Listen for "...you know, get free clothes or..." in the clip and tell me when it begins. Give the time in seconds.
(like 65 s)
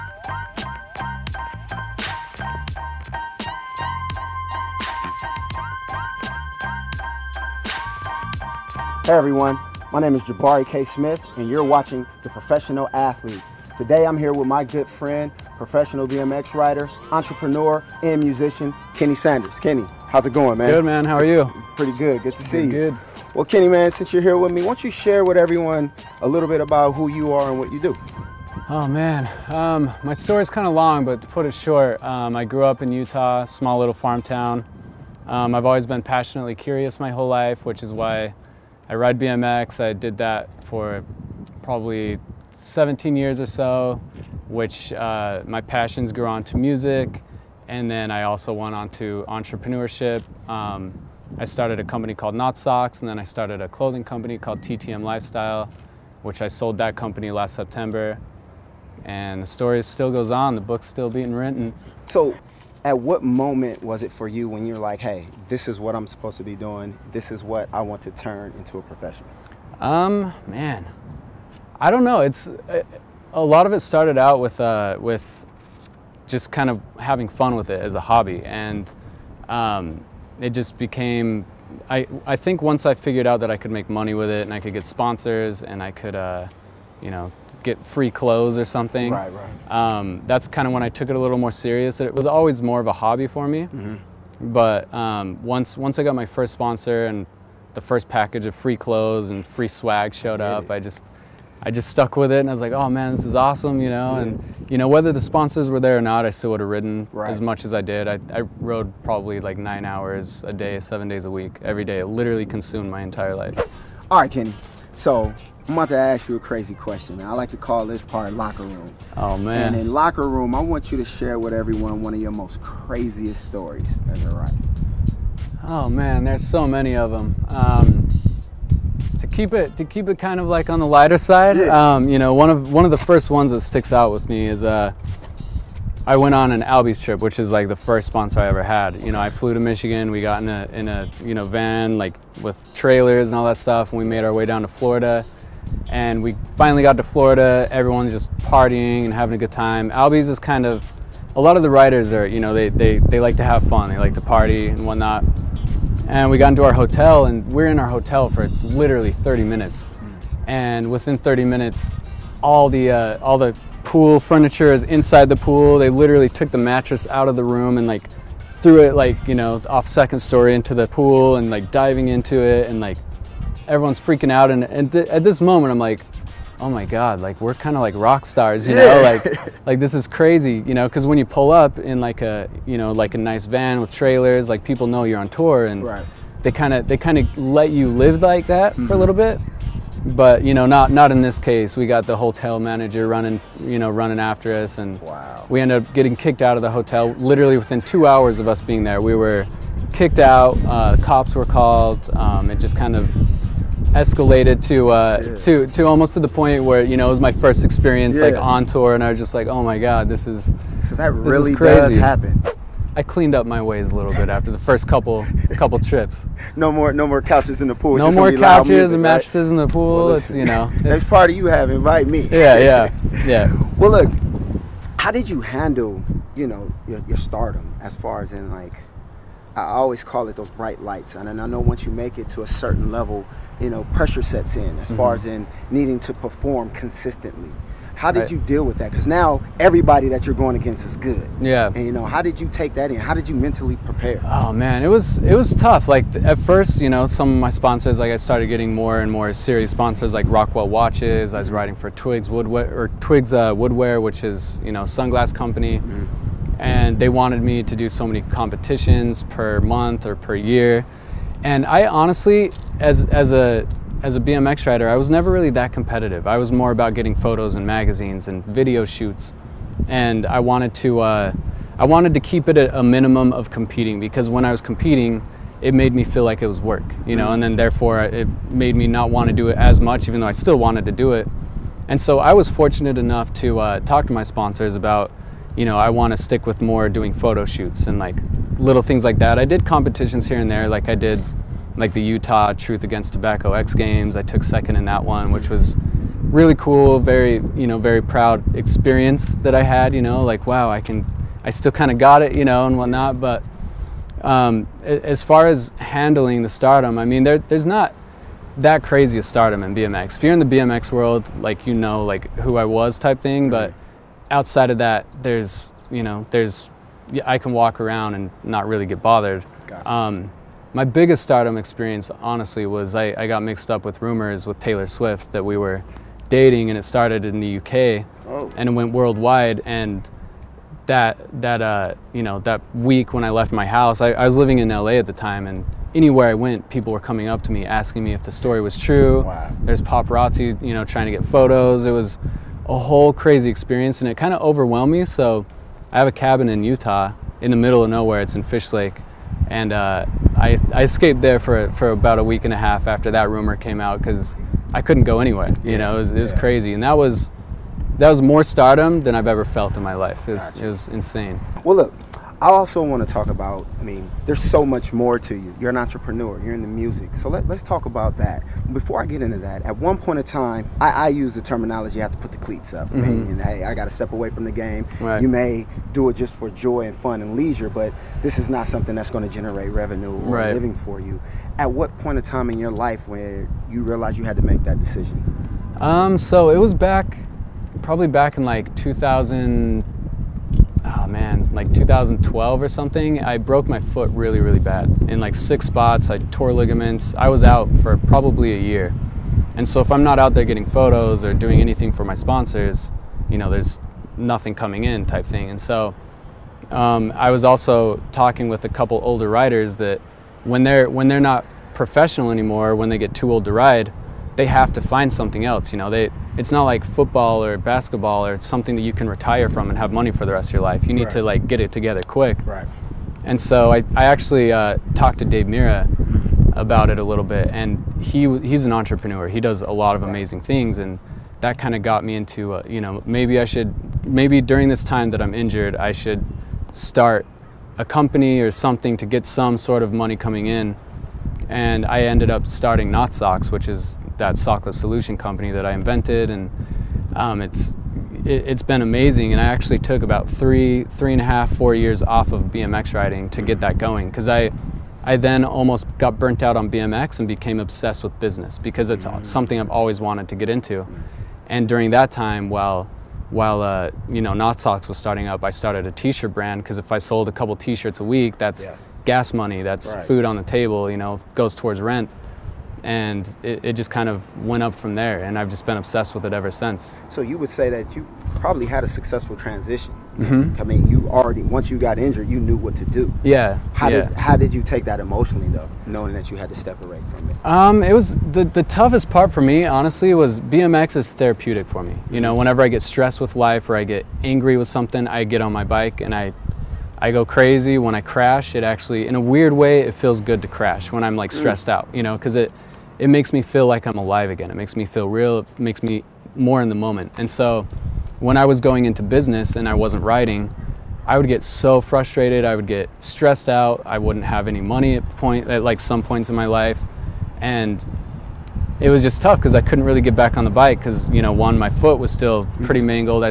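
87 s.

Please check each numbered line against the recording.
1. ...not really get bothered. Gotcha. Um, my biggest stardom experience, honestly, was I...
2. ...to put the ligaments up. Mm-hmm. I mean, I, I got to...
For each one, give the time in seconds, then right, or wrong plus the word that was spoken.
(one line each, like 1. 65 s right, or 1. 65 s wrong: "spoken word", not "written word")
1. 318 s right
2. 372 s wrong: "cleats", not "ligaments".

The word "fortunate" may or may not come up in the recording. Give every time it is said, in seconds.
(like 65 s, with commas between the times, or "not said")
282 s.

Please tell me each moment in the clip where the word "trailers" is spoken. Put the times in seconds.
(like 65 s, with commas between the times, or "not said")
142 s, 183 s.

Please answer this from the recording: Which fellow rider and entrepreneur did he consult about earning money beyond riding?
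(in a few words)
Dave Mirra.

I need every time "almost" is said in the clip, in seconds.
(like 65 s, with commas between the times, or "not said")
205 s, 455 s.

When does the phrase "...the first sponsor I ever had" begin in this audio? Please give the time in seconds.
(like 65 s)
137 s.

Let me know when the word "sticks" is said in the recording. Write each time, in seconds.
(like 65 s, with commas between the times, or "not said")
133 s, 286 s.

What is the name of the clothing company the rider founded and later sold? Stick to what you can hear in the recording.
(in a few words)
TTM Lifestyle.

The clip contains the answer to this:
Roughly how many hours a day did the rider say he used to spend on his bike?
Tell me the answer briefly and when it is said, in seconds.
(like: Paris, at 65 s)
9, at 109 s.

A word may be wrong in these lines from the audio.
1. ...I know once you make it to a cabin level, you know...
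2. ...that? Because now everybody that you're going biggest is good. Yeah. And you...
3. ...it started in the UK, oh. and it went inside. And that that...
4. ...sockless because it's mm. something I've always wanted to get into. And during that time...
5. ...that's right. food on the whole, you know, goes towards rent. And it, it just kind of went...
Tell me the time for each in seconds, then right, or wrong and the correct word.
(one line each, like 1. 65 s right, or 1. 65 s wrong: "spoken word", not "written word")
1. 231 s wrong: "certain", not "cabin"
2. 238 s wrong: "against", not "biggest"
3. 326 s wrong: "worldwide", not "inside"
4. 458 s wrong: "business", not "sockless"
5. 469 s wrong: "table", not "whole".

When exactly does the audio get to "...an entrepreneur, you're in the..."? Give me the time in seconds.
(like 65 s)
365 s.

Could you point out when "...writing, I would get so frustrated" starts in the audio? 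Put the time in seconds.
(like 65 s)
510 s.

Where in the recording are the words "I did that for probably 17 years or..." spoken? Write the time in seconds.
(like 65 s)
39 s.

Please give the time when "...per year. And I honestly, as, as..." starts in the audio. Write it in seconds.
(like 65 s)
260 s.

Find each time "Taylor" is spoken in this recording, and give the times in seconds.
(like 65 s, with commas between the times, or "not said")
324 s.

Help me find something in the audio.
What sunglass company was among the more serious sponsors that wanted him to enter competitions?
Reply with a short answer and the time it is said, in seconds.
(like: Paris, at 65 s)
Twigs Woodwear, at 251 s.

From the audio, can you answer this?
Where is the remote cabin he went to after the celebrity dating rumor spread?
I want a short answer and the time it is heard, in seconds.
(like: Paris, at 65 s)
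Fish Lake, at 348 s.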